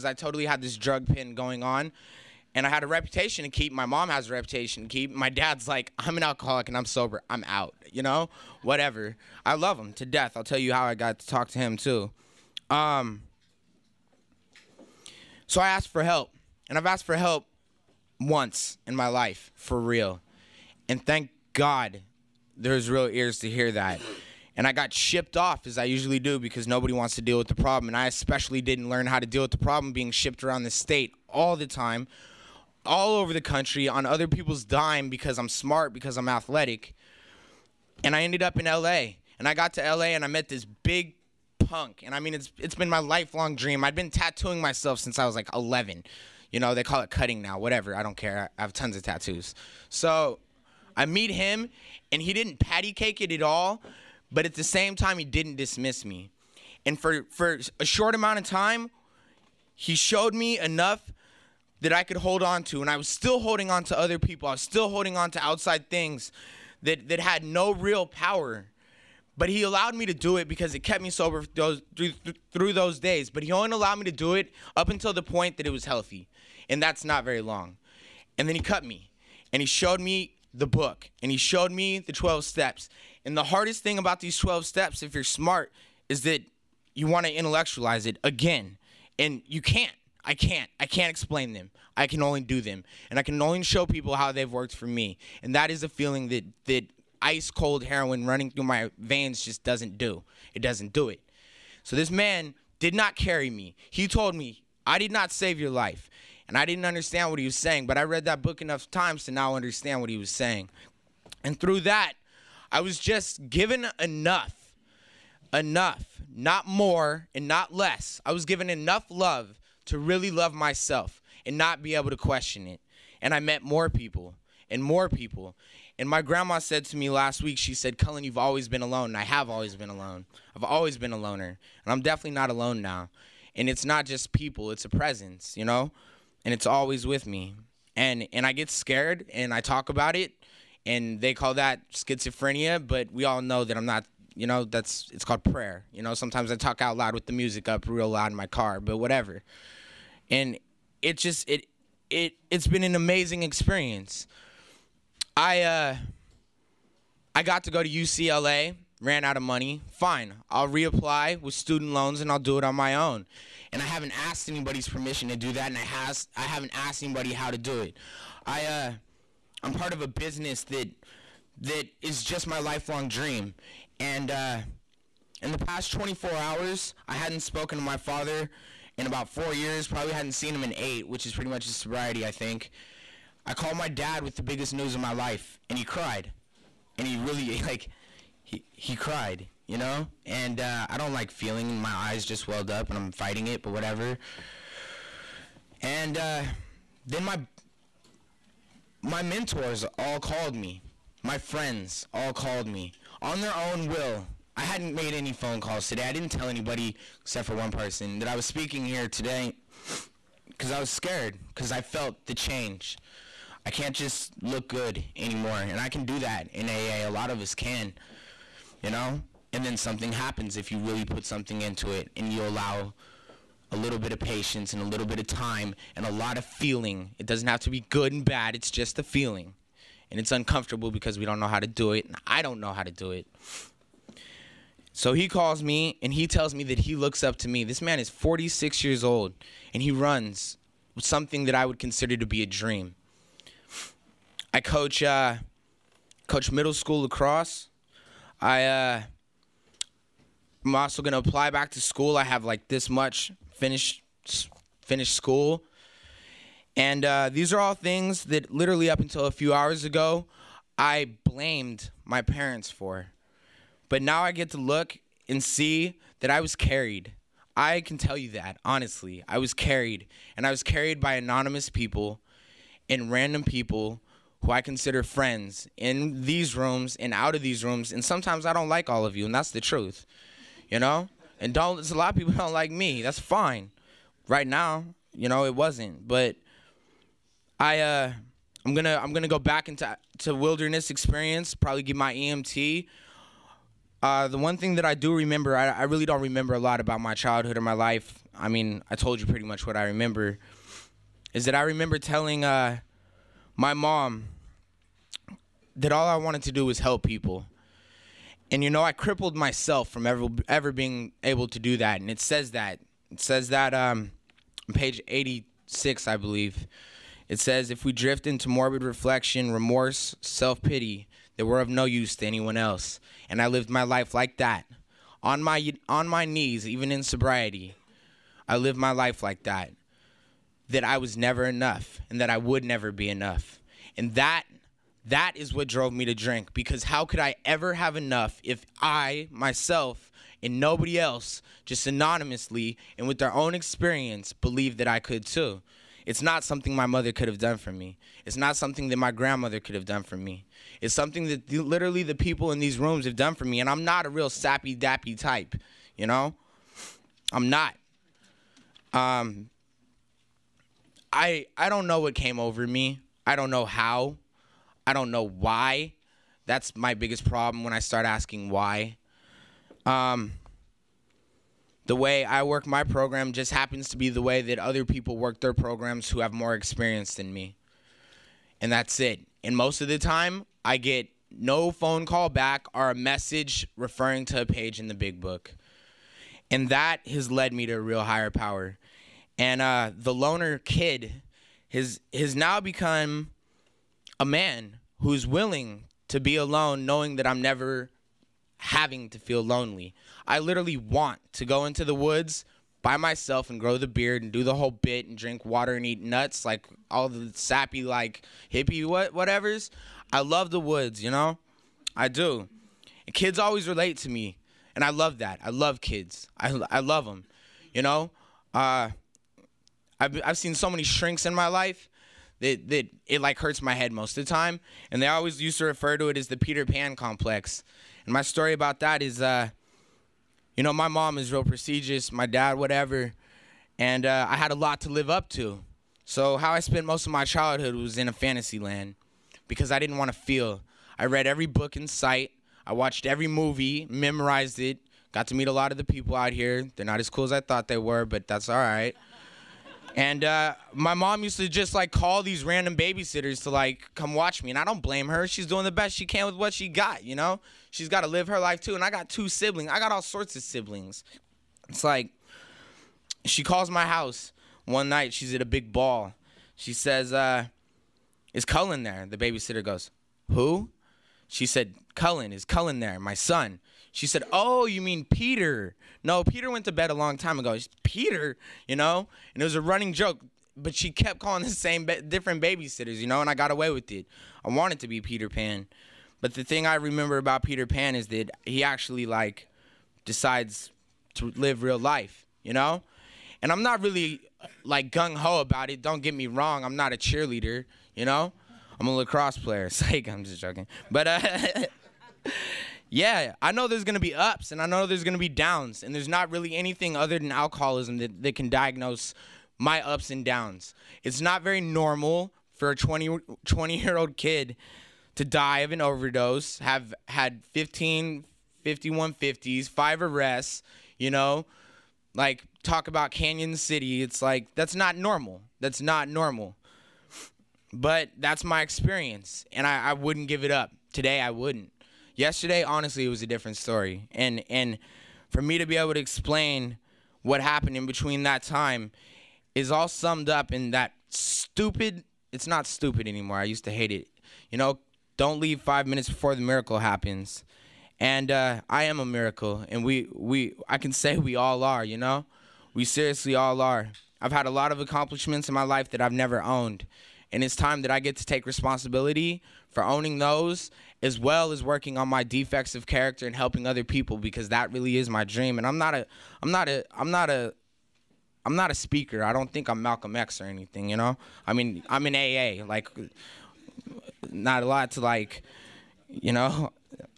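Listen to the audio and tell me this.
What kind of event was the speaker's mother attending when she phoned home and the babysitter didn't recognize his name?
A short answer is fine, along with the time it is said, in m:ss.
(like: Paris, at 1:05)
a big ball, at 7:45.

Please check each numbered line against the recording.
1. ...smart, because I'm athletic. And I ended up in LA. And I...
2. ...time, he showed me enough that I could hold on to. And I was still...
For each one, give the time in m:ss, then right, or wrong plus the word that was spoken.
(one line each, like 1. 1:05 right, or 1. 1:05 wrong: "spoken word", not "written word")
1. 0:35 right
2. 0:58 right.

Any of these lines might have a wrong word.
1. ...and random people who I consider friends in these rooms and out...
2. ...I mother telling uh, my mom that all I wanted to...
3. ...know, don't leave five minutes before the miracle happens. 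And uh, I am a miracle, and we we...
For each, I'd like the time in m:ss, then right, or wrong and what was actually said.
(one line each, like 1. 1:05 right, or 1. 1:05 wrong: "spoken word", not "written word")
1. 4:32 right
2. 5:01 wrong: "remember", not "mother"
3. 9:04 right.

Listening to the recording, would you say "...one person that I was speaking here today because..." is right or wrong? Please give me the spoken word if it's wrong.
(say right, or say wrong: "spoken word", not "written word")
right.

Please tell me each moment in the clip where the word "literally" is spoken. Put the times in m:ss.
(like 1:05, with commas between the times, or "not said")
4:18, 5:51, 6:40.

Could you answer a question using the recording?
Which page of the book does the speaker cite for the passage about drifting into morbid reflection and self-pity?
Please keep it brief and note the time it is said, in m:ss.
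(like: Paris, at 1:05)
86, at 5:14.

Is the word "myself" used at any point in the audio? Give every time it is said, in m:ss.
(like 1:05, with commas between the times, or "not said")
0:44, 2:00, 5:09, 5:39, 6:42.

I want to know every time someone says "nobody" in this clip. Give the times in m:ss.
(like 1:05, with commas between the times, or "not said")
0:26, 5:40.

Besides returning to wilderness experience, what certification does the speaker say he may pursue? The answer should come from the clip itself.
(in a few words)
EMT.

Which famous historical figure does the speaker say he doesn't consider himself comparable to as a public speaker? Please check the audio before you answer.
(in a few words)
Malcolm X.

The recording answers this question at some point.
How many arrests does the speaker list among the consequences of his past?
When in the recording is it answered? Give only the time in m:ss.
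8:39.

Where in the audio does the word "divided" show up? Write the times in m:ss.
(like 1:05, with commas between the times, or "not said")
not said.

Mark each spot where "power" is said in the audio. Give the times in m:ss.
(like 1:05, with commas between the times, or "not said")
1:08, 6:28.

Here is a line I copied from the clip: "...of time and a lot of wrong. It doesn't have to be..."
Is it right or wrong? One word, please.
wrong.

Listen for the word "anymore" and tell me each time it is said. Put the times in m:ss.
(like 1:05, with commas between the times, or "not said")
3:35, 9:03.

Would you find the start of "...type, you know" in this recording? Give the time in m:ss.
5:55.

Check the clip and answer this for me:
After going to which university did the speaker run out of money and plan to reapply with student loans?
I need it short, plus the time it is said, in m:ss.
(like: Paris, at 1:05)
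UCLA, at 2:37.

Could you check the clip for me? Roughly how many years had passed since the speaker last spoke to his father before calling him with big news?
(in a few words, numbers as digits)
4.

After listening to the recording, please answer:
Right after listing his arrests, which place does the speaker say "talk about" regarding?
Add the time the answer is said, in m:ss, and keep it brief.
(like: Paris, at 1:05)
Canyon City, at 8:43.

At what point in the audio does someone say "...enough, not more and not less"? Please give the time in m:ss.
1:55.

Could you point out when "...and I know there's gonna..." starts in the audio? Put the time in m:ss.
8:24.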